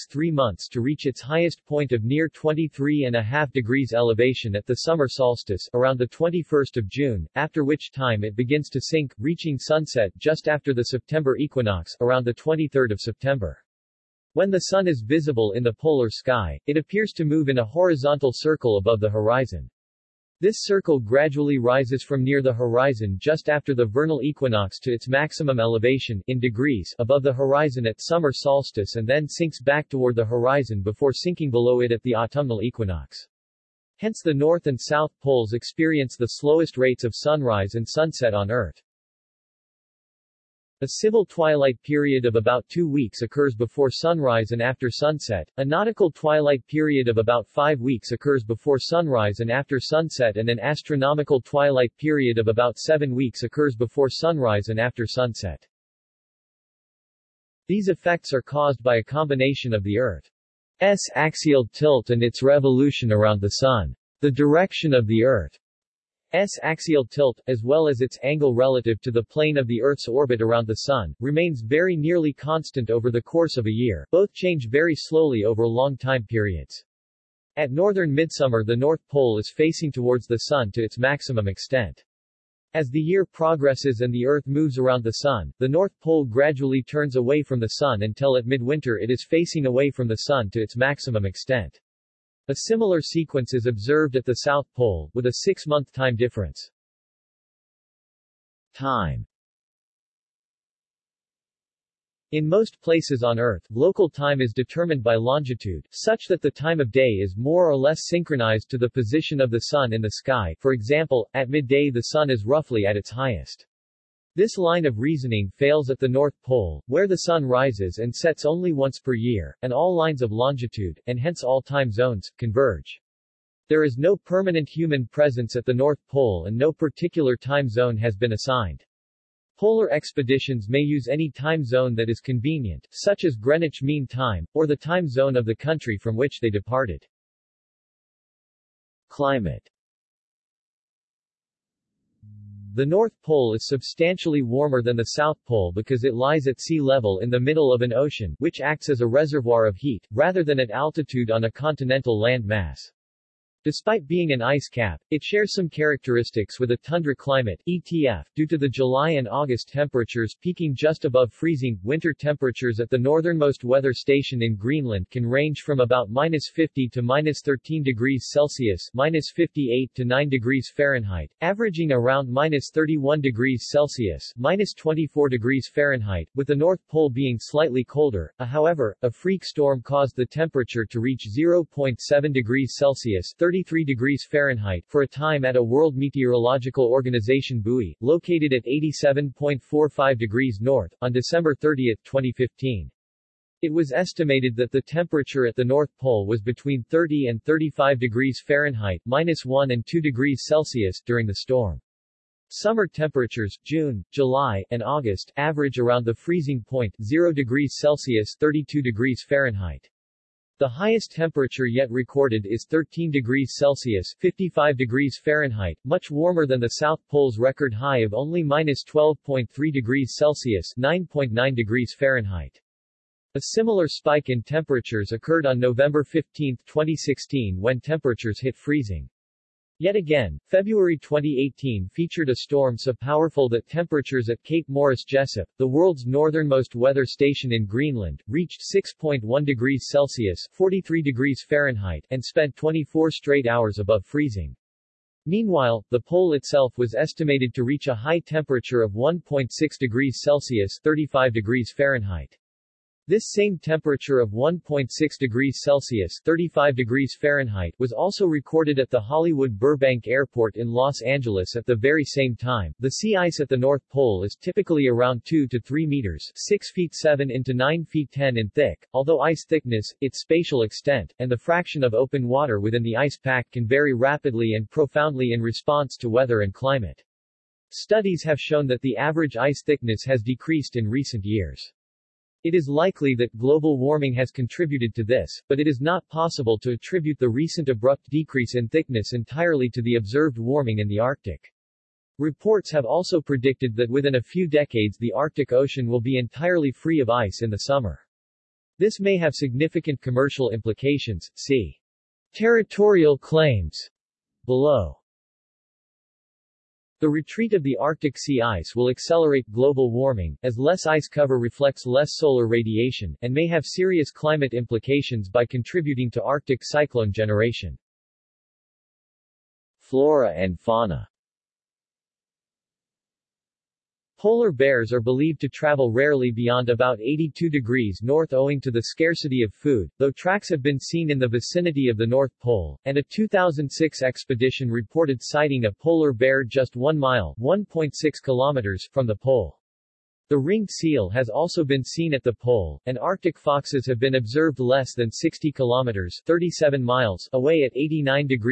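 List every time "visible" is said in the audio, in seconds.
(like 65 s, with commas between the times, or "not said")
15 s.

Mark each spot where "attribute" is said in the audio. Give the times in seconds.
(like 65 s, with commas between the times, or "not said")
286 s.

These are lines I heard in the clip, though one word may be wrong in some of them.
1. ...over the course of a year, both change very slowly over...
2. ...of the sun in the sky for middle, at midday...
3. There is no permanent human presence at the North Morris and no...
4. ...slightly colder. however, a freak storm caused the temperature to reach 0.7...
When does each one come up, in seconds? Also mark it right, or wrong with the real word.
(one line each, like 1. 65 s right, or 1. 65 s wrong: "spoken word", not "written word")
1. 72 s right
2. 109 s wrong: "example", not "middle"
3. 123 s wrong: "Pole", not "Morris"
4. 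177 s right.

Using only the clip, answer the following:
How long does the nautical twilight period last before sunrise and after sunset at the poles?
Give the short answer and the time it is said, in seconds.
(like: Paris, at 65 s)
About five weeks, at 47 s.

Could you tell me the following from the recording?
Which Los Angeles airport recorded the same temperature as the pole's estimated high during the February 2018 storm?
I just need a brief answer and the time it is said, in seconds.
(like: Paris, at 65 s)
Hollywood Burbank Airport, at 258 s.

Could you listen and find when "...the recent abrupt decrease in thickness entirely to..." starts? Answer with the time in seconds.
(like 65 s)
287 s.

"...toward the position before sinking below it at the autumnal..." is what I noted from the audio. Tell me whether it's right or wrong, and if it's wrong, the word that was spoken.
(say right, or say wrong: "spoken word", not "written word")
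wrong: "horizon", not "position".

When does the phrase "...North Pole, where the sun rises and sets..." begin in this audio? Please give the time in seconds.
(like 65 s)
116 s.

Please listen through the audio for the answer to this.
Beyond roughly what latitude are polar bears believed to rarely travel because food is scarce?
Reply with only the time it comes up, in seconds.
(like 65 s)
326 s.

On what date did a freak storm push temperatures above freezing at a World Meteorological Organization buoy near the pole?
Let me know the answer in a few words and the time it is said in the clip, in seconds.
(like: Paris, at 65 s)
December 30, 2015, at 191 s.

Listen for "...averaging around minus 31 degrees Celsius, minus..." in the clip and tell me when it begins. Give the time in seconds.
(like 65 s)
171 s.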